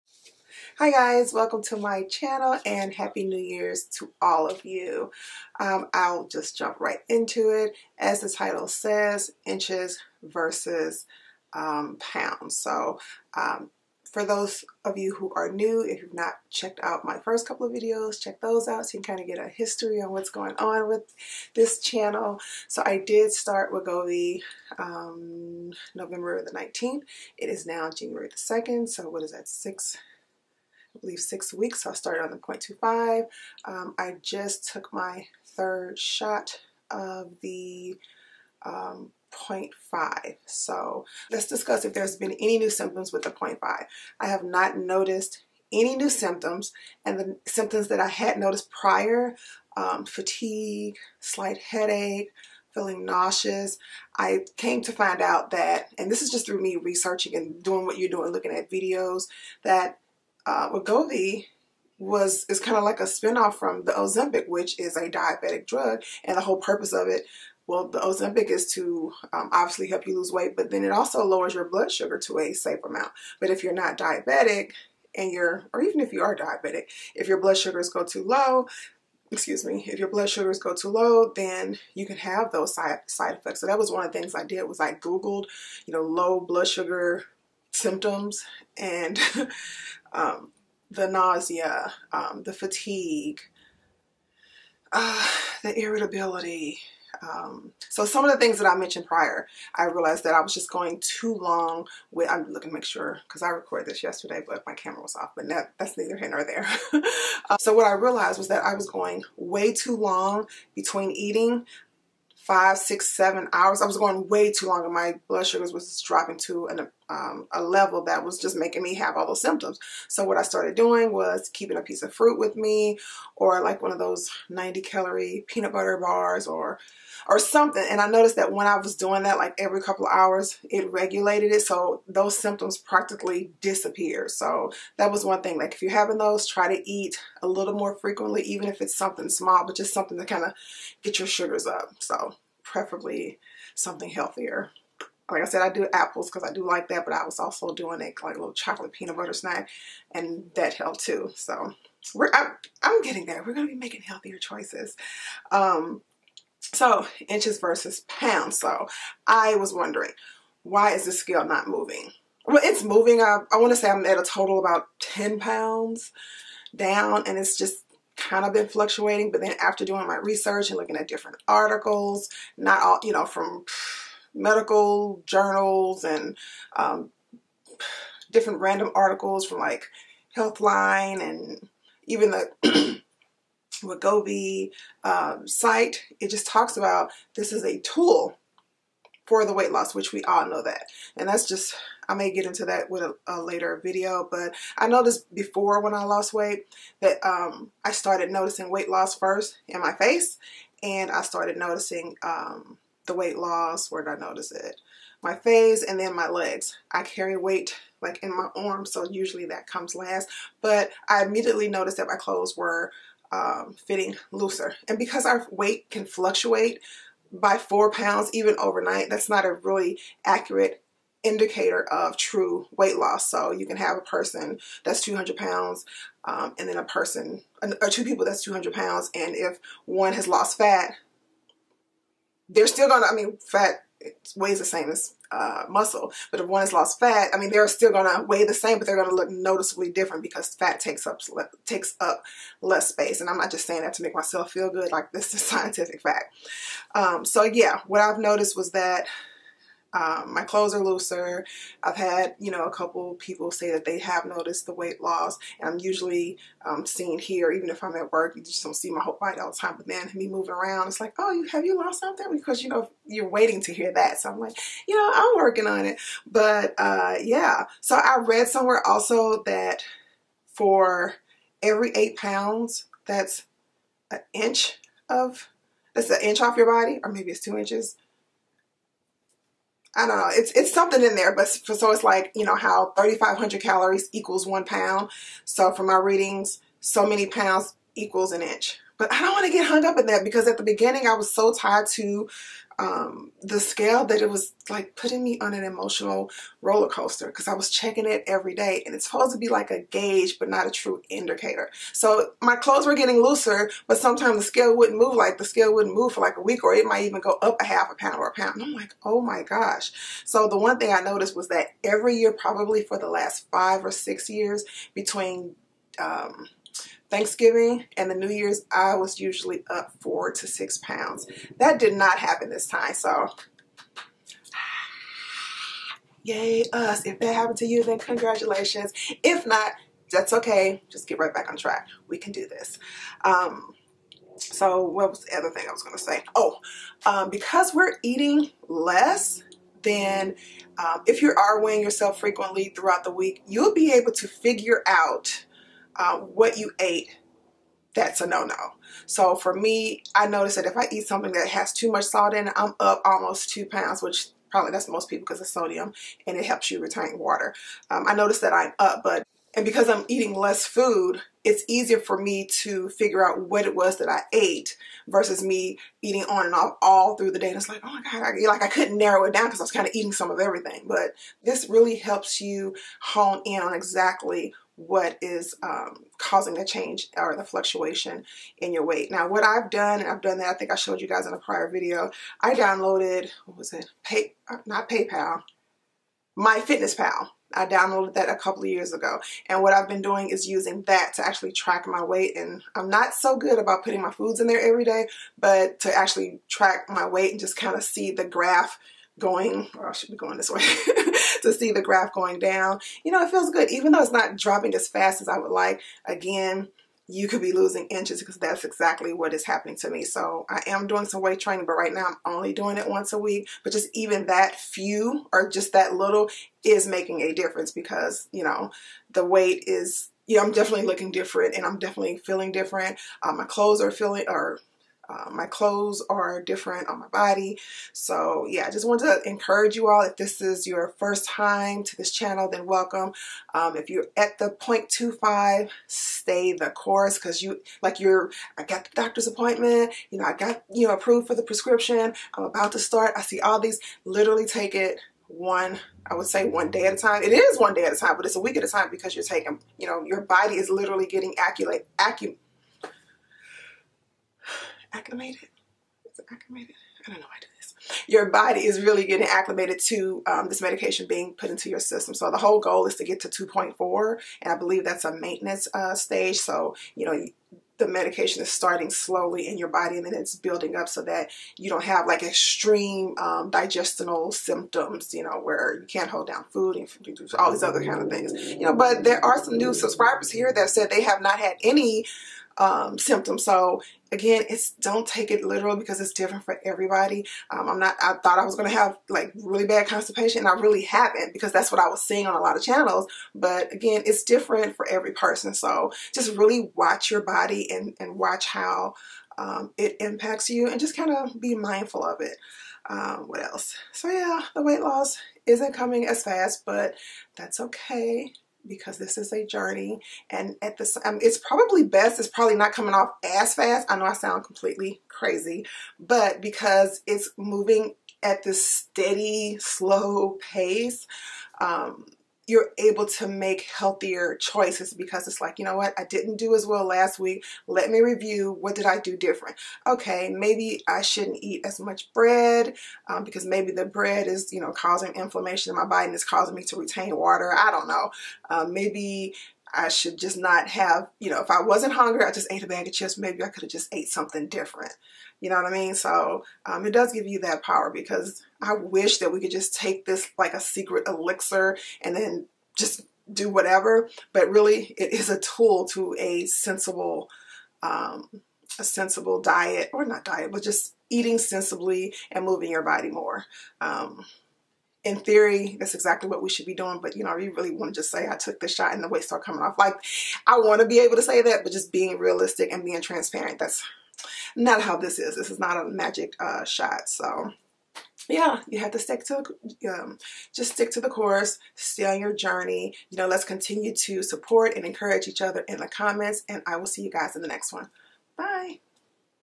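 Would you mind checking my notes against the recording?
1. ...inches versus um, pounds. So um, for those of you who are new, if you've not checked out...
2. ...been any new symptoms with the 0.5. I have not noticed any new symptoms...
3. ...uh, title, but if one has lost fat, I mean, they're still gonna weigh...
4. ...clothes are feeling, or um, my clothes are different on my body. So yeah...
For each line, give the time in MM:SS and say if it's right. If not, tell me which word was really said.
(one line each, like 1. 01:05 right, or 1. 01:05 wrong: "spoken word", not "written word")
1. 00:09 right
2. 00:42 right
3. 03:55 wrong: "muscle", not "title"
4. 07:03 right.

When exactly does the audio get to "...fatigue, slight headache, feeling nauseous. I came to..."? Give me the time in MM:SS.
00:50.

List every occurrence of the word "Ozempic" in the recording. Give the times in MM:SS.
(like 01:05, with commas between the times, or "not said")
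01:03, 01:07.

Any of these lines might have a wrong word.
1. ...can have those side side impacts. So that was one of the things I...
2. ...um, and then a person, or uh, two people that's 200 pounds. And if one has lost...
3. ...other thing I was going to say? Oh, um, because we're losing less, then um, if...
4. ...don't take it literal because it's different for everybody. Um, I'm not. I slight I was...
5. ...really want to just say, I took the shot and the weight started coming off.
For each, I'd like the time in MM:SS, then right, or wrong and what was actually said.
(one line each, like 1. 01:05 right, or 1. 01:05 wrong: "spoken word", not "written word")
1. 01:22 wrong: "effects", not "impacts"
2. 03:46 right
3. 05:35 wrong: "eating", not "losing"
4. 08:04 wrong: "thought", not "slight"
5. 09:27 right.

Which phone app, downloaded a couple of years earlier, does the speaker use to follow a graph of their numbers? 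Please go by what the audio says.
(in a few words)
MyFitnessPal.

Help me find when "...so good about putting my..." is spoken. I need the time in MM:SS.
06:33.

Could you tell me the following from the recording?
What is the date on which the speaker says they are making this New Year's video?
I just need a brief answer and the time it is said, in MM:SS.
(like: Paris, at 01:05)
January 2, at 00:27.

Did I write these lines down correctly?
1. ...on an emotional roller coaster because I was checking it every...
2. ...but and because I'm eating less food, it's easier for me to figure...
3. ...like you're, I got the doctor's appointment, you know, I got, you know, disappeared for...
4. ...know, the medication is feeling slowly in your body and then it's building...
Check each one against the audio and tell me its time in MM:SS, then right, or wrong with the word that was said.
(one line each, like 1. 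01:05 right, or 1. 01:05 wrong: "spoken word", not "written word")
1. 04:55 right
2. 05:59 right
3. 07:17 wrong: "approved", not "disappeared"
4. 07:47 wrong: "starting", not "feeling".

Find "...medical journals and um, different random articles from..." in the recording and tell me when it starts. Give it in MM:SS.
02:54.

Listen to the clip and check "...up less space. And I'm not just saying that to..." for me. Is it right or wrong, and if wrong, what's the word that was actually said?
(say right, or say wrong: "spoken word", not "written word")
right.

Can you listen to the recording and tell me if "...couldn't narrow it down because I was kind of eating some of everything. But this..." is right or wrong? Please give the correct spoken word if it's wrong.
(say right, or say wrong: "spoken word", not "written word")
right.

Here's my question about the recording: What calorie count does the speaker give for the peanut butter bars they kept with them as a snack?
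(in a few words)
90.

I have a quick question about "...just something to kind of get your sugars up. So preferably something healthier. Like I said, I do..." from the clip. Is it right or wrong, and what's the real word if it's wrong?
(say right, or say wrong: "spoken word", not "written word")
right.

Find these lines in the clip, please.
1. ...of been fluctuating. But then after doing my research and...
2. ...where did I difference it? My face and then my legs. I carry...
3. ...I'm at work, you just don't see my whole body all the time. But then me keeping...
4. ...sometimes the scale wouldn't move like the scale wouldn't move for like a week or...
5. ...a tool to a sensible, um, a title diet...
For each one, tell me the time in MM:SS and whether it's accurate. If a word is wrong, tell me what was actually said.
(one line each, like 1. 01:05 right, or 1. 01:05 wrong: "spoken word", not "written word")
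1. 02:48 right
2. 03:23 wrong: "notice", not "difference"
3. 04:17 wrong: "moving", not "keeping"
4. 05:03 right
5. 09:15 wrong: "sensible", not "title".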